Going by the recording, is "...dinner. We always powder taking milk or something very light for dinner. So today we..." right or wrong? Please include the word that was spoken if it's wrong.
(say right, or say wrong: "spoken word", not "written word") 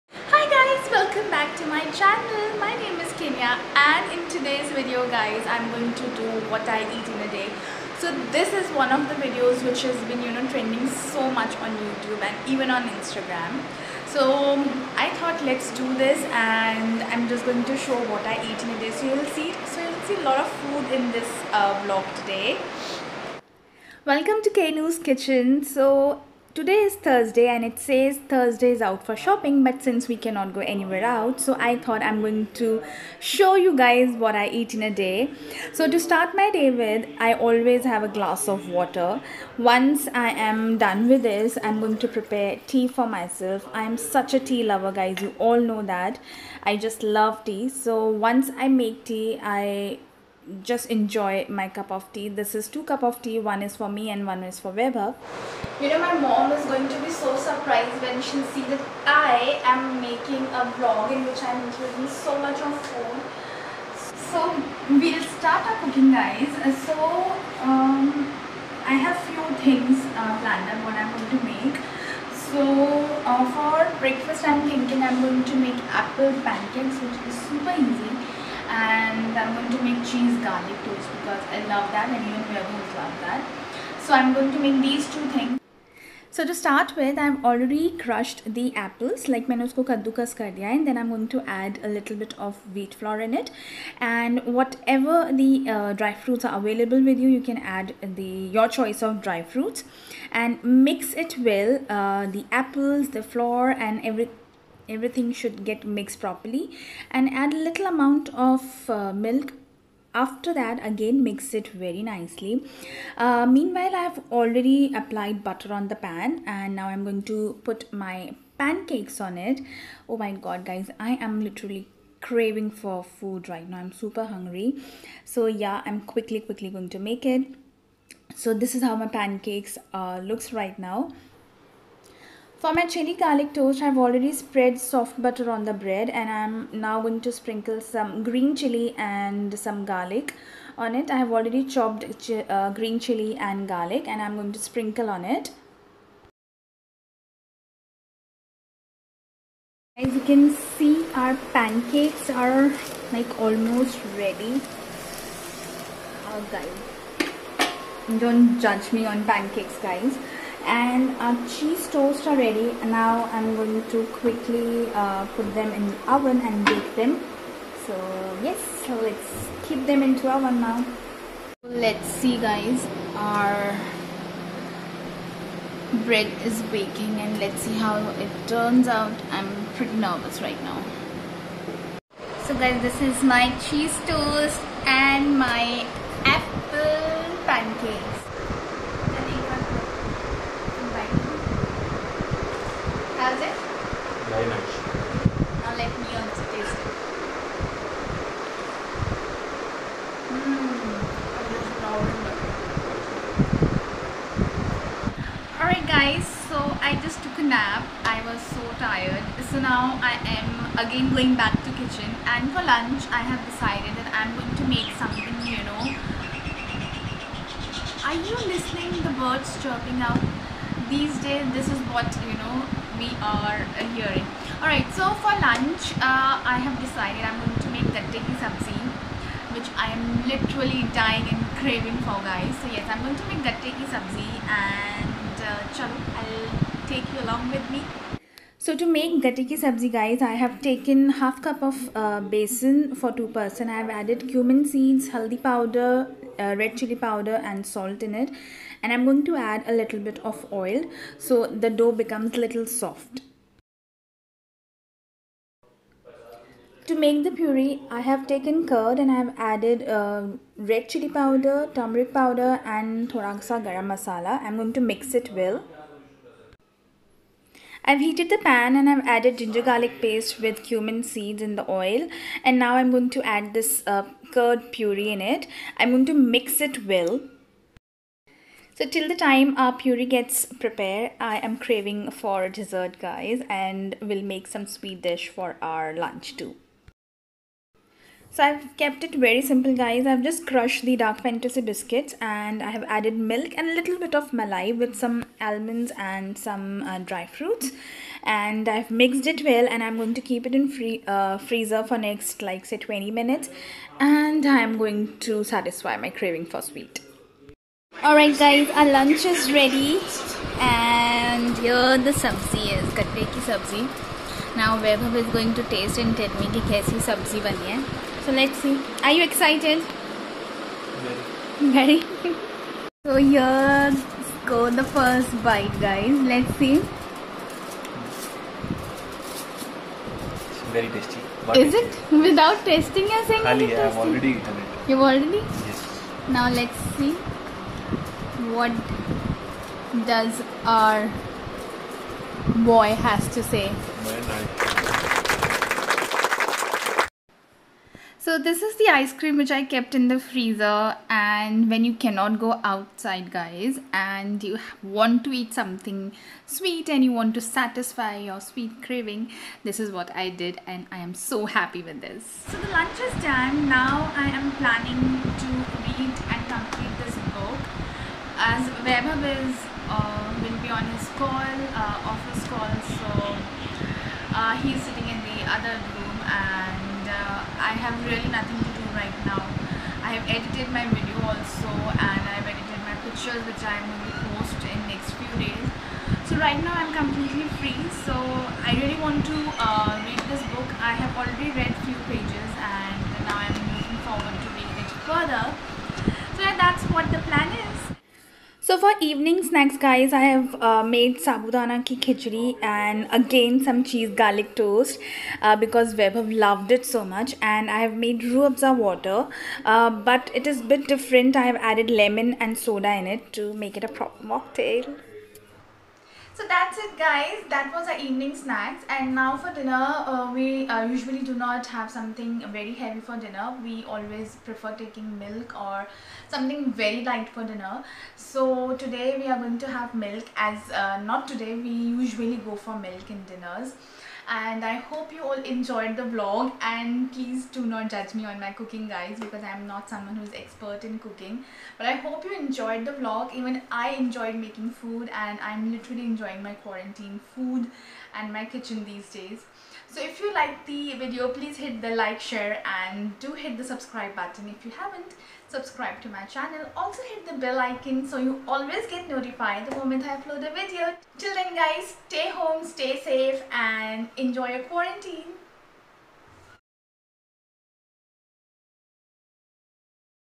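wrong: "prefer", not "powder".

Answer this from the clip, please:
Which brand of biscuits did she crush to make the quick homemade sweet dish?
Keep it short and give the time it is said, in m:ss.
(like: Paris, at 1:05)
Dark Fantasy, at 4:50.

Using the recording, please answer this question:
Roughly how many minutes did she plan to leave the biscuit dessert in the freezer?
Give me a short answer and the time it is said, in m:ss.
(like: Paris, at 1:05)
20, at 5:02.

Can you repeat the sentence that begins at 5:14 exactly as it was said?
Now Vaibhav is going to taste and tell me ki kaisi sabzi bani hai.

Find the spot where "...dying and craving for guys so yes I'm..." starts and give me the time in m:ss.
3:50.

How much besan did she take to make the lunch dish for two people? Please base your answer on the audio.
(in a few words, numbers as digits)
Half cup.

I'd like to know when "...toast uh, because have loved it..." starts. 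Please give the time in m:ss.
6:44.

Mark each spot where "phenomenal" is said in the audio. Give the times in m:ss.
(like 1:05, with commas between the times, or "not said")
not said.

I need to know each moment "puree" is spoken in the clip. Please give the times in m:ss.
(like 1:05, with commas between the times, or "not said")
4:17, 4:34, 4:39.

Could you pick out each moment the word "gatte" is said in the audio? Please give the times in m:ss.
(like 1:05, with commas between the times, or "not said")
3:47, 3:53, 3:59, 5:12.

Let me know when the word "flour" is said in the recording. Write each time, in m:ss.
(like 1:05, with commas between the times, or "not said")
1:32, 1:43.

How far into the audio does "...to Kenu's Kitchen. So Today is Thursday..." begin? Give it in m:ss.
0:24.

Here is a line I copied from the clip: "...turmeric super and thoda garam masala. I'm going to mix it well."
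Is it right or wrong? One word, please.
wrong.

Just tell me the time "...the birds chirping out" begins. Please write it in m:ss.
3:39.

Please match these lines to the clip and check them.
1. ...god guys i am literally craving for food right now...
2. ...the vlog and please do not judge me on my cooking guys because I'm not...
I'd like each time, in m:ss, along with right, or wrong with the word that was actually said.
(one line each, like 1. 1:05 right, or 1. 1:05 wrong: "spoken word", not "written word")
1. 2:00 right
2. 7:15 right.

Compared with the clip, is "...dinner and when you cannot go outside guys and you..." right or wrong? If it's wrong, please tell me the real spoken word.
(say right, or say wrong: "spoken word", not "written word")
wrong: "freezer", not "dinner".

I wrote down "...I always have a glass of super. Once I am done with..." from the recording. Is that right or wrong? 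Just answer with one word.
wrong.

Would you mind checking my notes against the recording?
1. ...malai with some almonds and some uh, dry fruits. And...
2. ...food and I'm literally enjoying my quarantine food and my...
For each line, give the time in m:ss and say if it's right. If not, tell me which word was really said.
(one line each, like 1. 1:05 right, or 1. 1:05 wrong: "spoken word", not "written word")
1. 4:54 right
2. 7:24 right.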